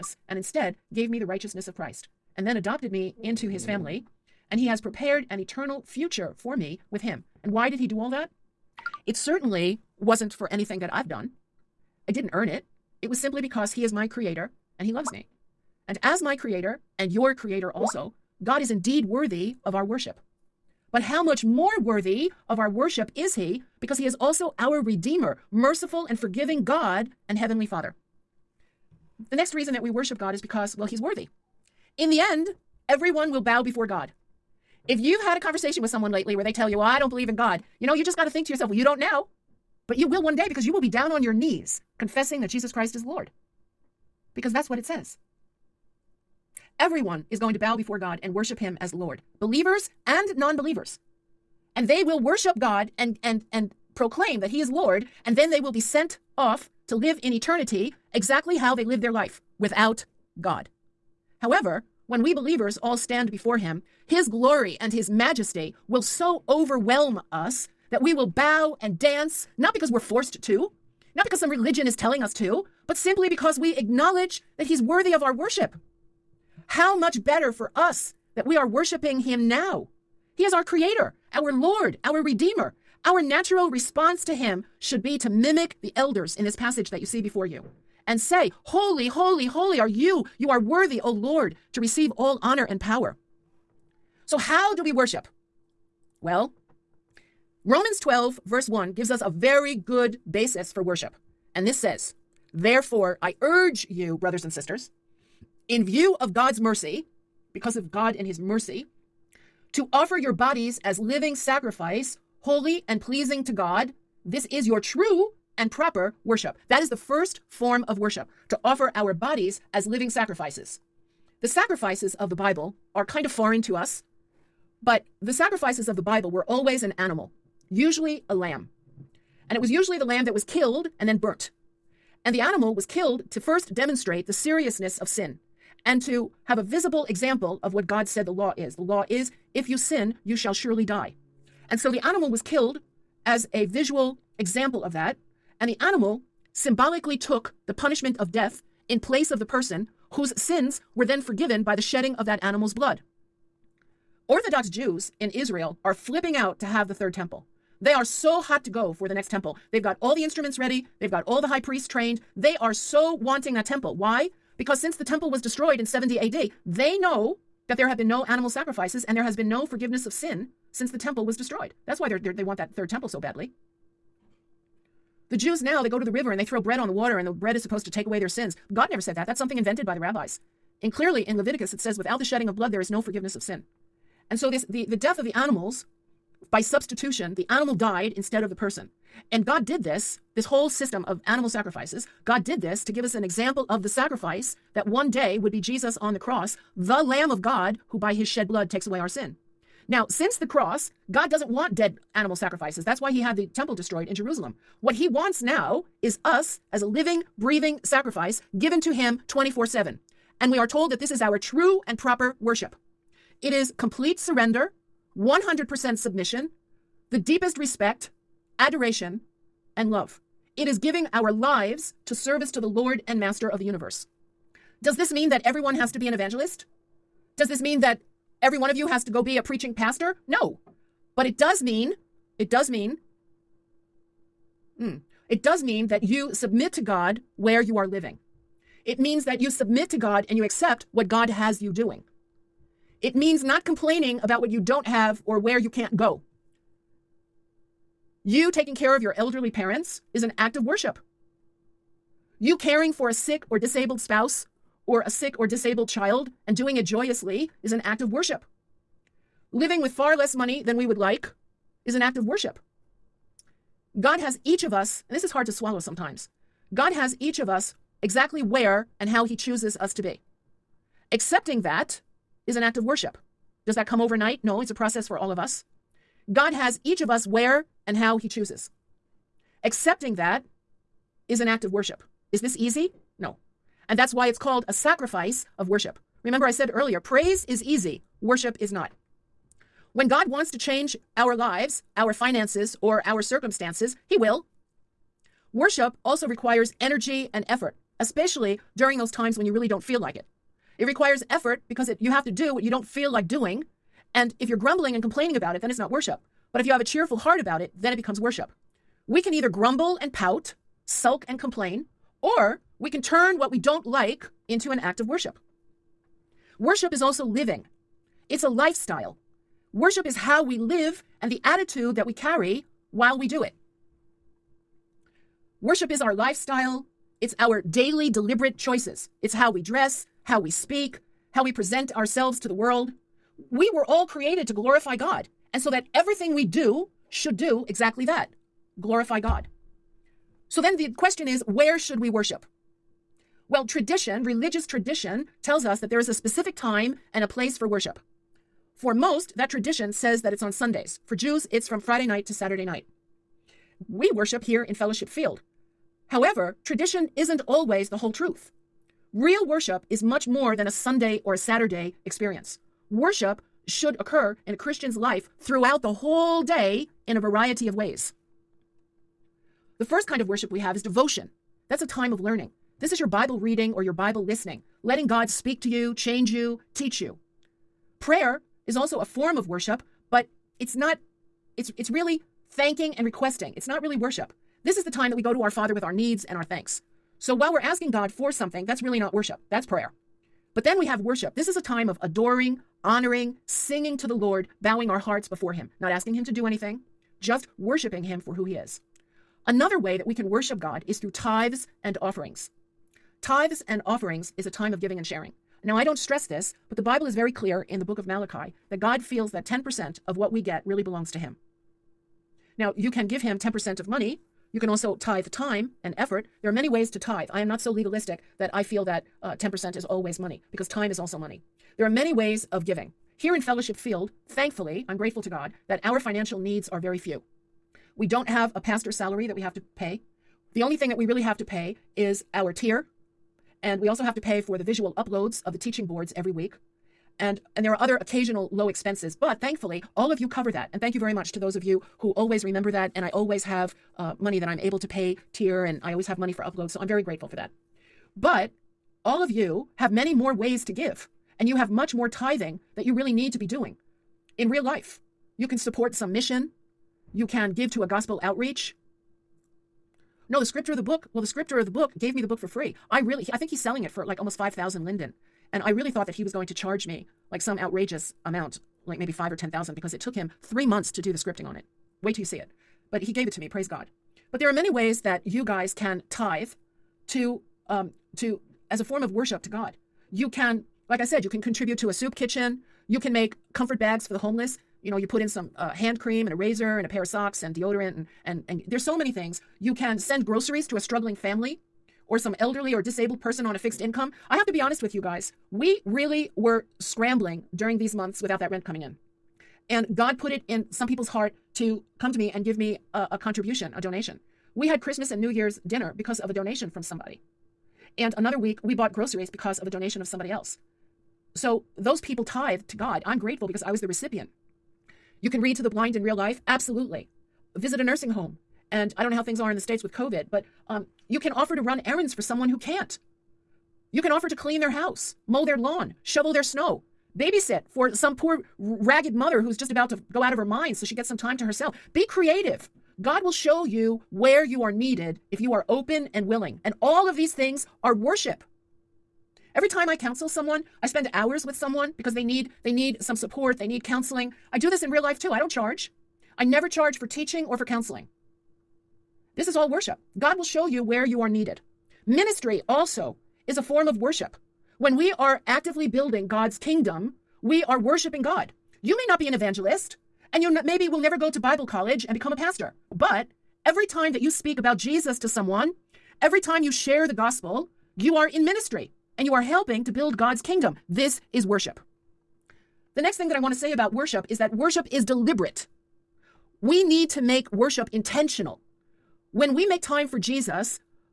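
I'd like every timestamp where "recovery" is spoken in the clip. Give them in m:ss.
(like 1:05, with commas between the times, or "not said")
not said.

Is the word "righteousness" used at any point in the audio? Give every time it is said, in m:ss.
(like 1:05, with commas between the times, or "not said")
0:01.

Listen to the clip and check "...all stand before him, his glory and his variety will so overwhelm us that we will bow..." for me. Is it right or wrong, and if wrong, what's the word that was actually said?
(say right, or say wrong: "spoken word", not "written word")
wrong: "majesty", not "variety".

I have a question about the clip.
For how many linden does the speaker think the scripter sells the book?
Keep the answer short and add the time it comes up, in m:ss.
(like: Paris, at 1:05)
almost 5,000 linden, at 7:44.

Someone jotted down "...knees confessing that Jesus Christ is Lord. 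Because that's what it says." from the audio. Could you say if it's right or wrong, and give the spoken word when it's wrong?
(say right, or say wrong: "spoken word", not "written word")
right.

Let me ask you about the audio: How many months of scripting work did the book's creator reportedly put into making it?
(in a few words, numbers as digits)
3 months.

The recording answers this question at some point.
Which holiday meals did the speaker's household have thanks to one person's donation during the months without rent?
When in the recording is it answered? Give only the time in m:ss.
8:24.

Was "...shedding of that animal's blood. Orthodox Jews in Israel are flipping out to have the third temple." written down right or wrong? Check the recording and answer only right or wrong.
right.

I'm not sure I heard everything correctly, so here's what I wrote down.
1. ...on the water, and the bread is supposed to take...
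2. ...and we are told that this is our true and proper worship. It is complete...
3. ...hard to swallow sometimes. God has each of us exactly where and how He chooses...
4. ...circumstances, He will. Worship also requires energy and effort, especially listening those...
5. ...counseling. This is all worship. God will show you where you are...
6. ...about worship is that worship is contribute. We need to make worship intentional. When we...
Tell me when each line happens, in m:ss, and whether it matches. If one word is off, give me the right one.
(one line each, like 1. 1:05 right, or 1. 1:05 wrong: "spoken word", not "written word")
1. 2:56 right
2. 3:30 right
3. 4:25 right
4. 4:53 wrong: "during", not "listening"
5. 9:07 right
6. 9:33 wrong: "deliberate", not "contribute".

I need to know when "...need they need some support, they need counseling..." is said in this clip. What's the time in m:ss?
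9:02.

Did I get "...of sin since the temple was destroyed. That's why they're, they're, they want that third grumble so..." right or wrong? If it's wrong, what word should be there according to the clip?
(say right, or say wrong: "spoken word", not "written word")
wrong: "temple", not "grumble".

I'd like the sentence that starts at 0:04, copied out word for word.
And he has prepared an eternal future for me with him.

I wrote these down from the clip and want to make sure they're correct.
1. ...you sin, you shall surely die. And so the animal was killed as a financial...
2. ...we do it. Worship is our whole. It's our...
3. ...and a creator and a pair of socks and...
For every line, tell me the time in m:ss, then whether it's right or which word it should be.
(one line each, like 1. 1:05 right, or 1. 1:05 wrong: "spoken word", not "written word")
1. 2:19 wrong: "visual", not "financial"
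2. 5:23 wrong: "lifestyle", not "whole"
3. 8:06 wrong: "razor", not "creator".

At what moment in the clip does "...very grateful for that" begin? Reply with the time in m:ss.
7:26.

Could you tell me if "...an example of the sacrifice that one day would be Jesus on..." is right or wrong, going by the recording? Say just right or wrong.
right.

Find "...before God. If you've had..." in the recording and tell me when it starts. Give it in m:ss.
0:33.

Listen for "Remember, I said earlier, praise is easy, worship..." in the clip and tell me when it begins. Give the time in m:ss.
4:46.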